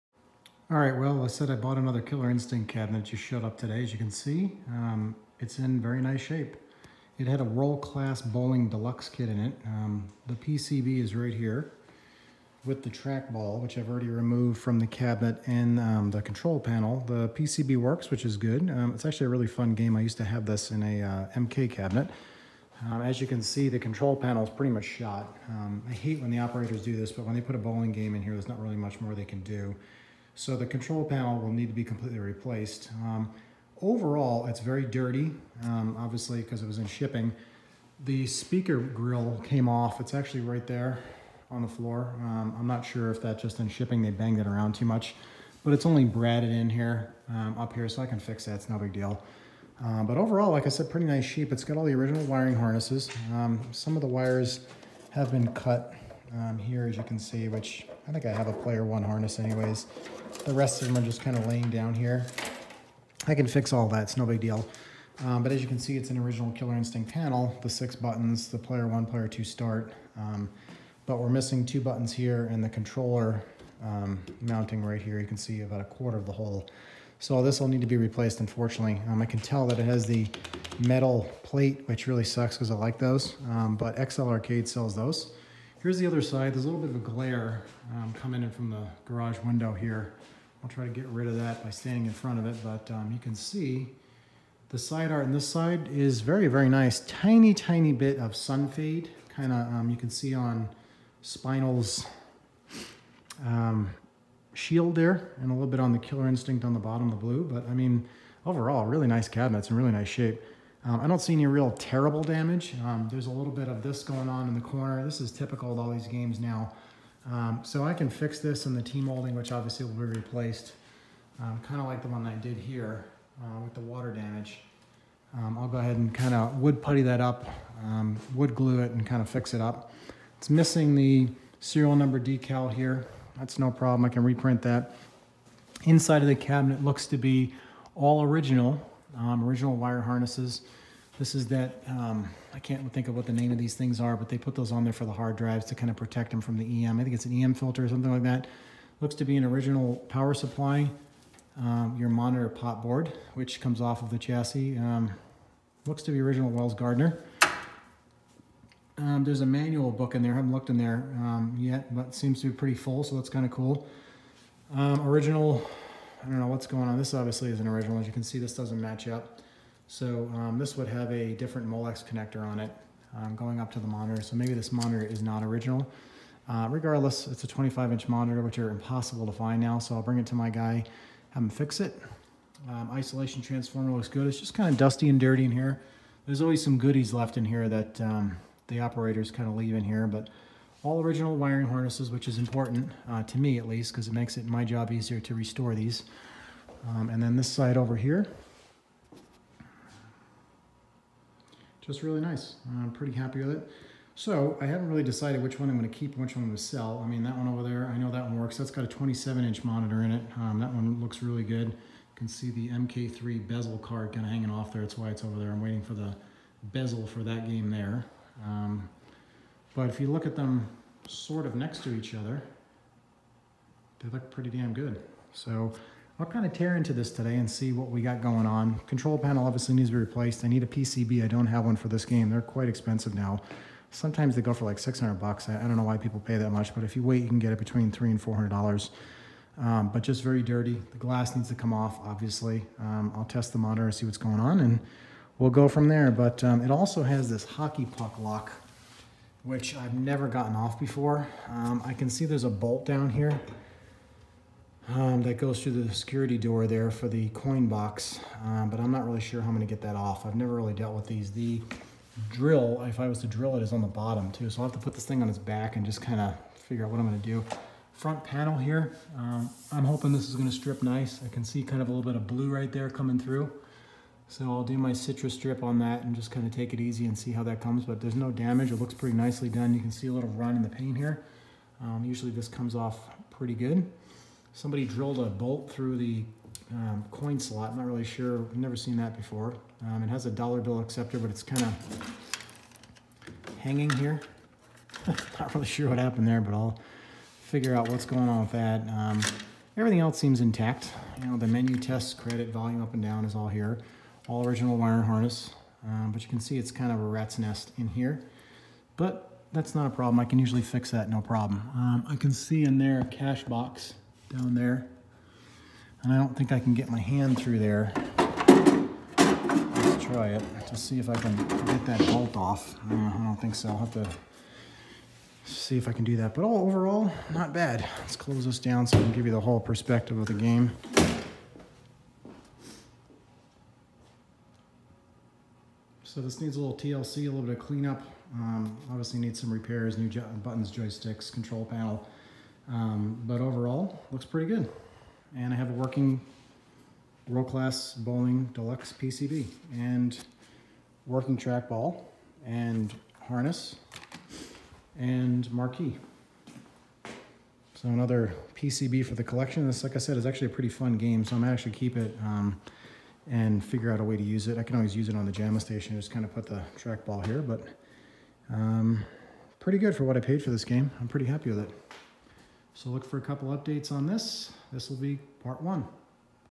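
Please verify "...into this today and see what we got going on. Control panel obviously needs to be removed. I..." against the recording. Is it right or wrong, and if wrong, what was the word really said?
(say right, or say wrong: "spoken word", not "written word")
wrong: "replaced", not "removed".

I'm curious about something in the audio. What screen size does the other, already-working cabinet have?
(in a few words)
27-inch.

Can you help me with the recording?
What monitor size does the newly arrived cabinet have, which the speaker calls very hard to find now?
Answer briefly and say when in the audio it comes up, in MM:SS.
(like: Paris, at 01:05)
25 inch, at 02:57.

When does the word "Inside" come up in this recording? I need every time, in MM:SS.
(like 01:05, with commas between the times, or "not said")
02:15.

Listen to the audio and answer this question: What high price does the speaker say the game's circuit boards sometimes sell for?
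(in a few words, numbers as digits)
$600.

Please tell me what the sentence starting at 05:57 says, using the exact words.
So another PCB for the collection.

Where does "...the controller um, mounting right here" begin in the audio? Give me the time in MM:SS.
01:12.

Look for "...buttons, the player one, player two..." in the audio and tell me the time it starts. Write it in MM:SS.
01:07.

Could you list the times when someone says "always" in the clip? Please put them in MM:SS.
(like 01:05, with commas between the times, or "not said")
03:06, 06:04.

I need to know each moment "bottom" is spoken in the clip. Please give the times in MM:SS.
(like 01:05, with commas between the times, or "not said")
01:46, 04:23.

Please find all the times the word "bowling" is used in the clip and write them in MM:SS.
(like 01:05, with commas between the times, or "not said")
00:08, 00:27, 05:47.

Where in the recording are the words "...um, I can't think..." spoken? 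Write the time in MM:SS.
02:21.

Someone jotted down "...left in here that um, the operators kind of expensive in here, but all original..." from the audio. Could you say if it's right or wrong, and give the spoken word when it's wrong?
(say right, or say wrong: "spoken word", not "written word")
wrong: "leave", not "expensive".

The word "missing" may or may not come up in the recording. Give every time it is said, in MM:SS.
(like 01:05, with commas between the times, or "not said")
01:11, 02:10.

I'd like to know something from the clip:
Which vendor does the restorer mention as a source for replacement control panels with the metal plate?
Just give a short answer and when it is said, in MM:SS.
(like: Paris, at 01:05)
XL Arcade, at 01:24.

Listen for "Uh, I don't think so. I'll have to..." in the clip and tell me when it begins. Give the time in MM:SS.
05:22.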